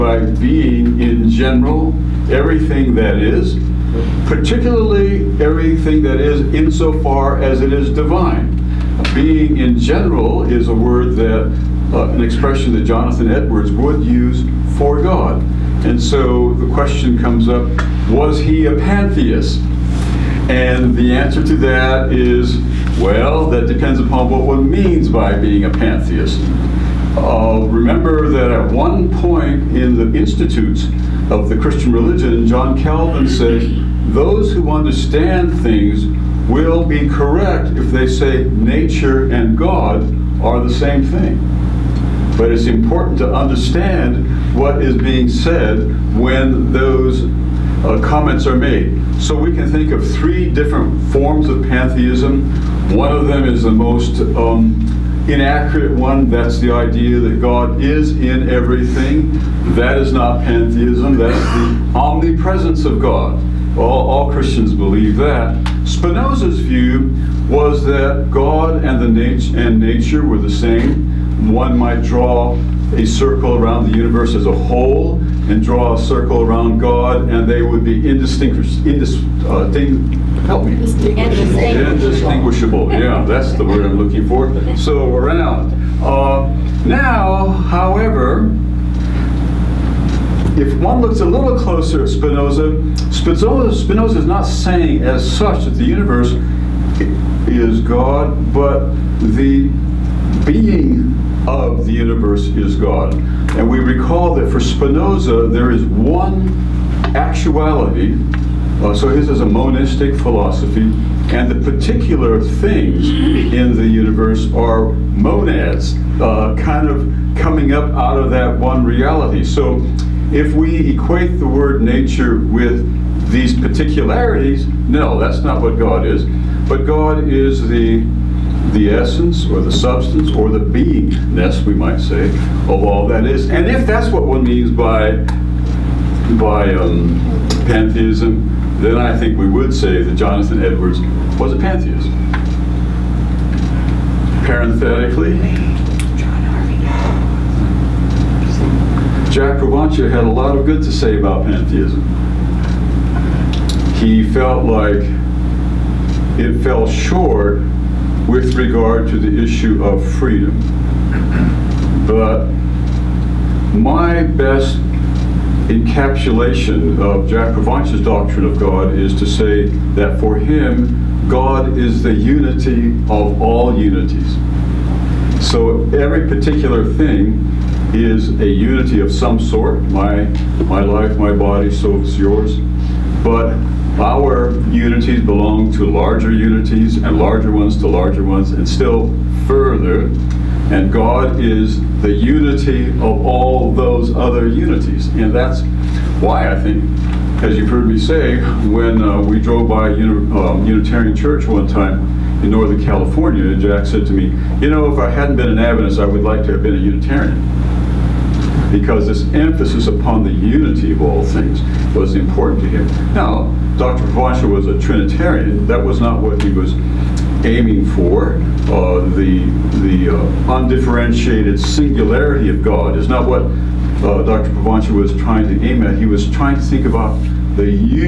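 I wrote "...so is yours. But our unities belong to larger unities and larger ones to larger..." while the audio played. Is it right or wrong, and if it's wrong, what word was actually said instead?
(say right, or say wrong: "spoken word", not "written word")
right.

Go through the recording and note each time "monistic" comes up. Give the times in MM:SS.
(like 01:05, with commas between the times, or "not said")
01:49.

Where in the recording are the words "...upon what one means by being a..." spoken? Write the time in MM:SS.
00:23.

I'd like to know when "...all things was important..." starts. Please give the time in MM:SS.
03:31.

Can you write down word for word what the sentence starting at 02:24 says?
Parenthetically, Jack Provonsha had a lot of good to say about pantheism.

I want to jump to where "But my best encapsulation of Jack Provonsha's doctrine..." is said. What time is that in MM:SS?
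02:42.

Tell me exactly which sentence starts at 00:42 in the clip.
But it's important to understand what is being said when those uh, comments are made.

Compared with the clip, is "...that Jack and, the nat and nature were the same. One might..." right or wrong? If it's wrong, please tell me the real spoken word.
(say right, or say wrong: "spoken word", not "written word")
wrong: "God", not "Jack".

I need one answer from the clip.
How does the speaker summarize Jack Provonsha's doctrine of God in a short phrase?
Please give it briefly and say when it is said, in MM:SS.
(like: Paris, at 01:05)
The unity of all unities, at 02:52.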